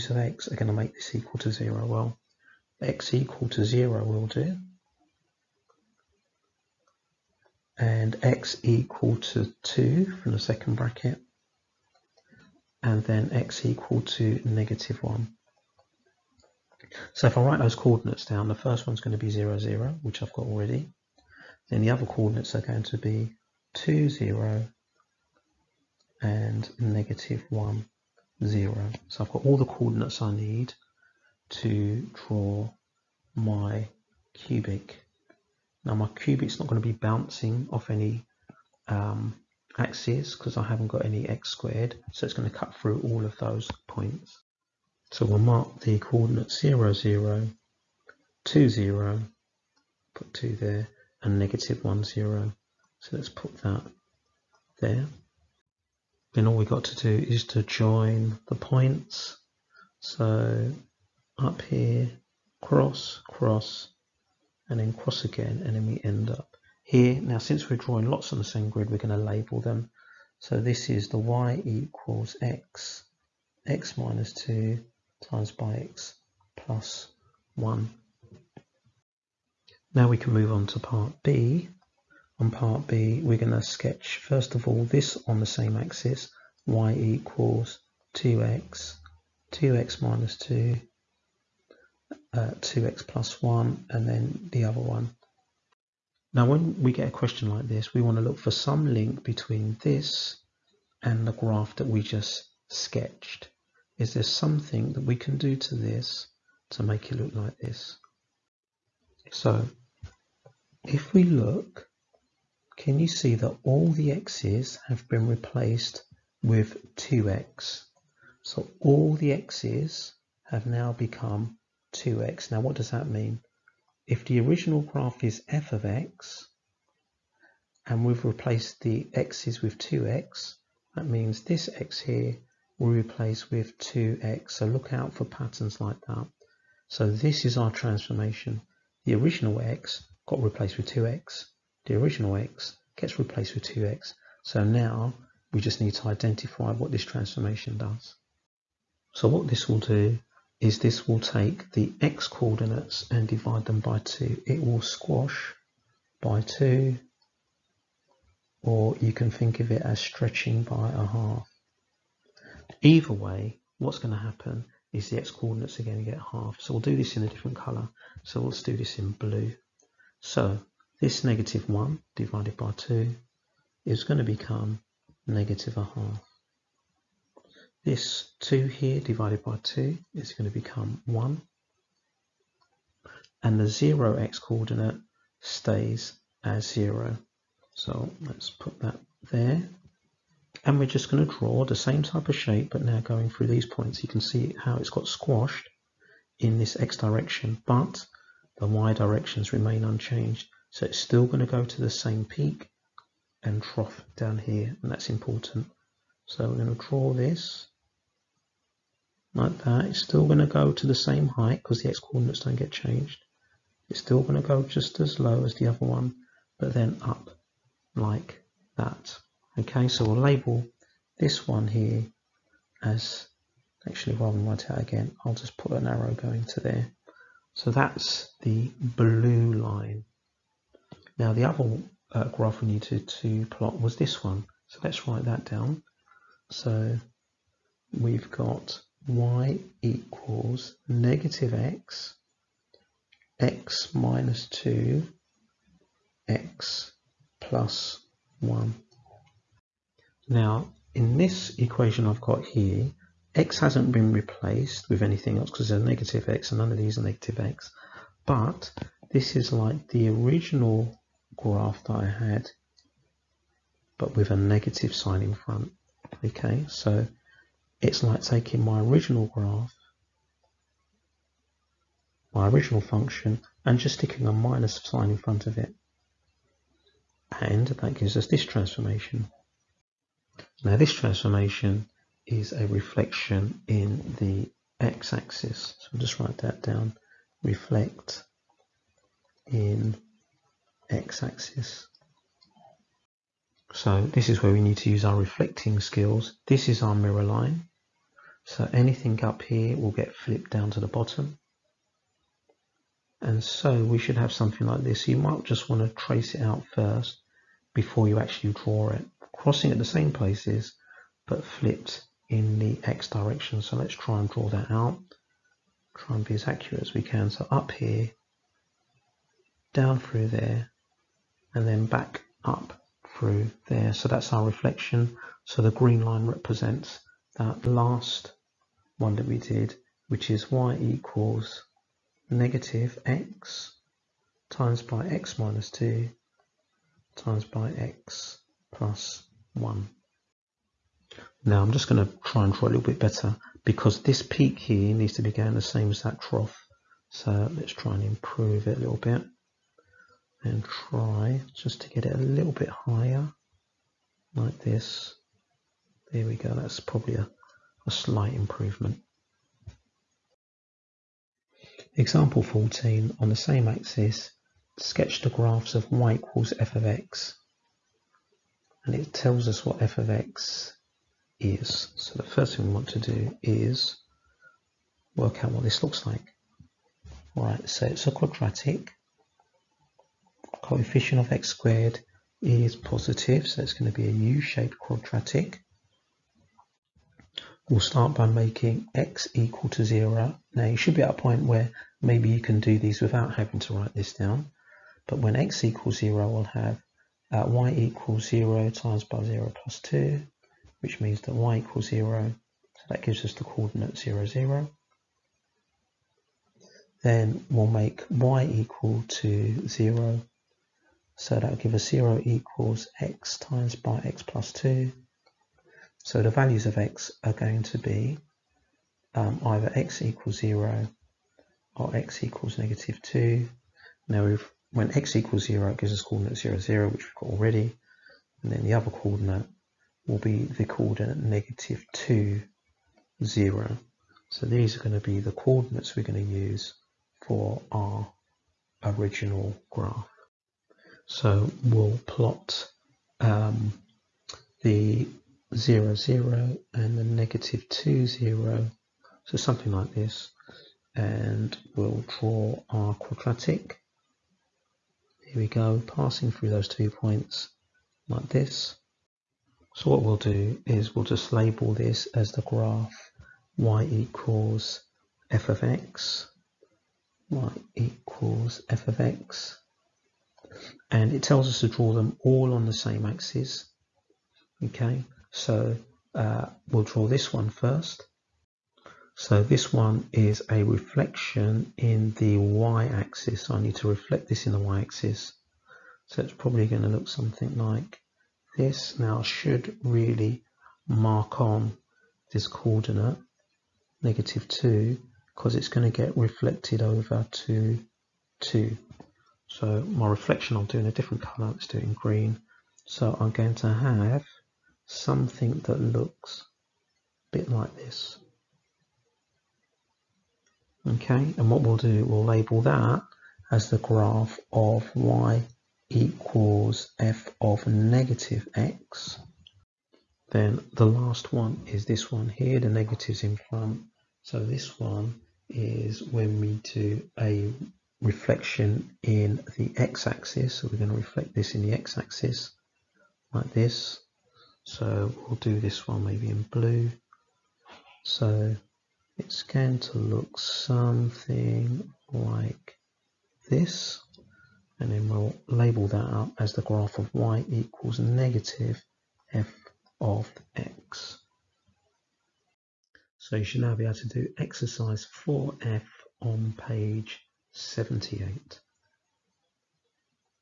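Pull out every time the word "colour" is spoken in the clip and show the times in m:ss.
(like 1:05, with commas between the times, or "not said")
2:47, 8:21.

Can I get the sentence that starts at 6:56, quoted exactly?
So the values of x are going to be um, either x equals 0 or x equals negative 2.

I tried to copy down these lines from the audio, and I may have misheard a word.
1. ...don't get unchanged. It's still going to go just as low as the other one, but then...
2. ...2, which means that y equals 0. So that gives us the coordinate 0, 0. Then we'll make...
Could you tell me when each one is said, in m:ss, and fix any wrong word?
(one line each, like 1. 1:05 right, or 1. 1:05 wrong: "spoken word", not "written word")
1. 3:32 wrong: "changed", not "unchanged"
2. 6:39 right.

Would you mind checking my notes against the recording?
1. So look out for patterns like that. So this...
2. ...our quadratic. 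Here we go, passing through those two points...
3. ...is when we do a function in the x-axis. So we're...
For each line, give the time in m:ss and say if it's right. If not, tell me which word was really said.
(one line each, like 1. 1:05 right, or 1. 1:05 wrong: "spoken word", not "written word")
1. 2:14 right
2. 7:32 right
3. 8:45 wrong: "reflection", not "function".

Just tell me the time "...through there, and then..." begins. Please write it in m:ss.
5:19.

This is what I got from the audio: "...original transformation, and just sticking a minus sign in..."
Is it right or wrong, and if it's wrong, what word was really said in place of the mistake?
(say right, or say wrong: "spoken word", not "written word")
wrong: "function", not "transformation".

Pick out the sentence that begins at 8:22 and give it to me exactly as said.
So I'm going to have something that looks a bit like this.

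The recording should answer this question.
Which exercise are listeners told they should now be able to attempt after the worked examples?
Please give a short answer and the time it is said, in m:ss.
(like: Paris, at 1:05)
4f, at 9:14.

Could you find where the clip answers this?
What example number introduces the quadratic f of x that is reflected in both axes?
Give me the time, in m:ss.
6:01.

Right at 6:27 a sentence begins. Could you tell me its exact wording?
We'll start by making x equal to 0.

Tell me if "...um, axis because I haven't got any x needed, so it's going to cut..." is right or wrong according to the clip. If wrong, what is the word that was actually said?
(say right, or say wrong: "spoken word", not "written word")
wrong: "squared", not "needed".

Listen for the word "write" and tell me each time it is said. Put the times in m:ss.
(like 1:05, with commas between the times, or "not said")
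0:17, 3:44, 3:55, 4:46, 6:33.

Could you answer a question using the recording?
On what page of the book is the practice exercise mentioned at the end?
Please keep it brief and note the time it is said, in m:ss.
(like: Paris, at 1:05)
78, at 9:16.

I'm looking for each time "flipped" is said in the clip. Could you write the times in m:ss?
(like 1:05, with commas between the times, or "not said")
5:00, 5:11.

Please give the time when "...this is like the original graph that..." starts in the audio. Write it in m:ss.
4:19.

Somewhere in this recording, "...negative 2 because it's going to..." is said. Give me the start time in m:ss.
8:14.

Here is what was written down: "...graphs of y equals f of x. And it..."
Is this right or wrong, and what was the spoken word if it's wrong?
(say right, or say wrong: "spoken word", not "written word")
right.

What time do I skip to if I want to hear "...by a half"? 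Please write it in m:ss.
2:40.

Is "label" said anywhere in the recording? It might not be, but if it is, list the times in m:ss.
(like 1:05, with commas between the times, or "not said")
1:09, 3:40, 7:41, 8:32, 9:05.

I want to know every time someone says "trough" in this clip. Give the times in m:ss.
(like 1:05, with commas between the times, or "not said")
3:23, 5:46.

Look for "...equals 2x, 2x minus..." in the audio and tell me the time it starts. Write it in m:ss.
1:26.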